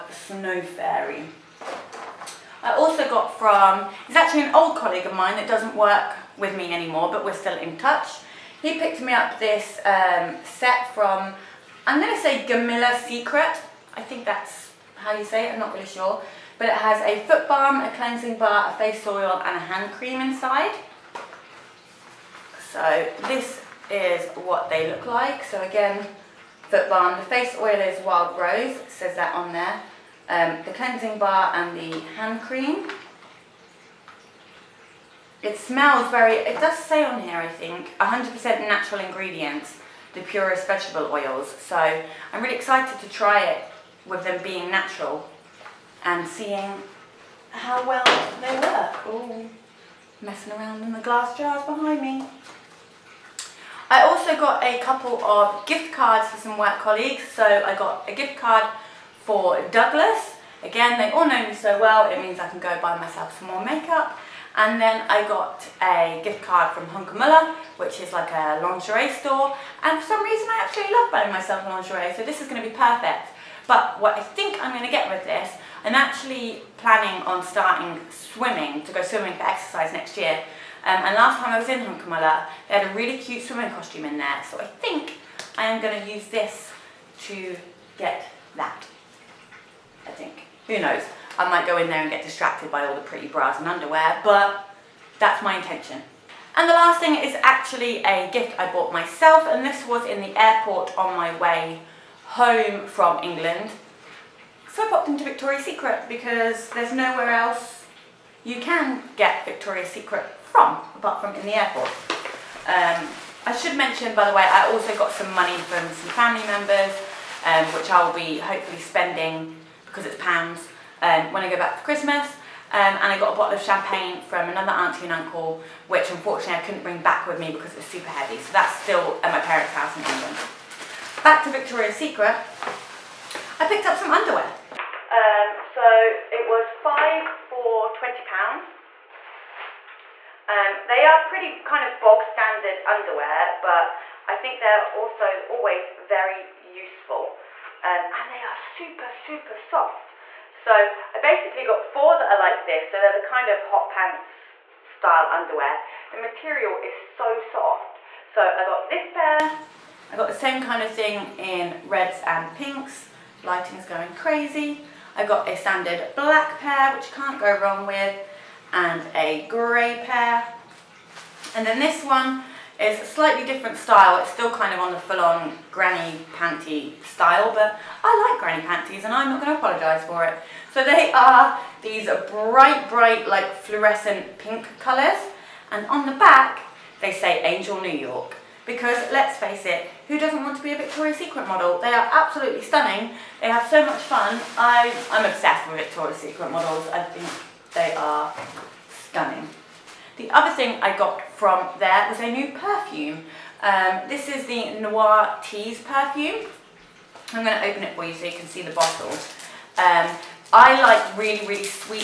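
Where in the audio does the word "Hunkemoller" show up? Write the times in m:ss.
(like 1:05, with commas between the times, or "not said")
1:06, 1:21.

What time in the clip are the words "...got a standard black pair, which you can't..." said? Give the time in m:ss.
2:45.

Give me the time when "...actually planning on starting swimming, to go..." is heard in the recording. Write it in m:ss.
1:15.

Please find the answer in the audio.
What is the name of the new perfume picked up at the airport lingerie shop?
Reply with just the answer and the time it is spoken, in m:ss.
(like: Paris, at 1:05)
Noir Tease, at 3:24.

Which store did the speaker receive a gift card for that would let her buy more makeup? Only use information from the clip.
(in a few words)
Douglas.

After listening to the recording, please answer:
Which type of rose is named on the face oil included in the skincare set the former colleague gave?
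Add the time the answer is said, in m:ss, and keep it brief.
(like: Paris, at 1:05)
Wild Rose, at 0:28.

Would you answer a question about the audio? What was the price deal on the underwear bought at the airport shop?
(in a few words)
5 for £20.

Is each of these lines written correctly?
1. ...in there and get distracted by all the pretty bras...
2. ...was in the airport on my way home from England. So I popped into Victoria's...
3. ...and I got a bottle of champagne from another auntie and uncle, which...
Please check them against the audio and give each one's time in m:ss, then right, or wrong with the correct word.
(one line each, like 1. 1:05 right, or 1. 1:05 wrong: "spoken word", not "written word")
1. 1:31 right
2. 1:39 right
3. 2:03 right.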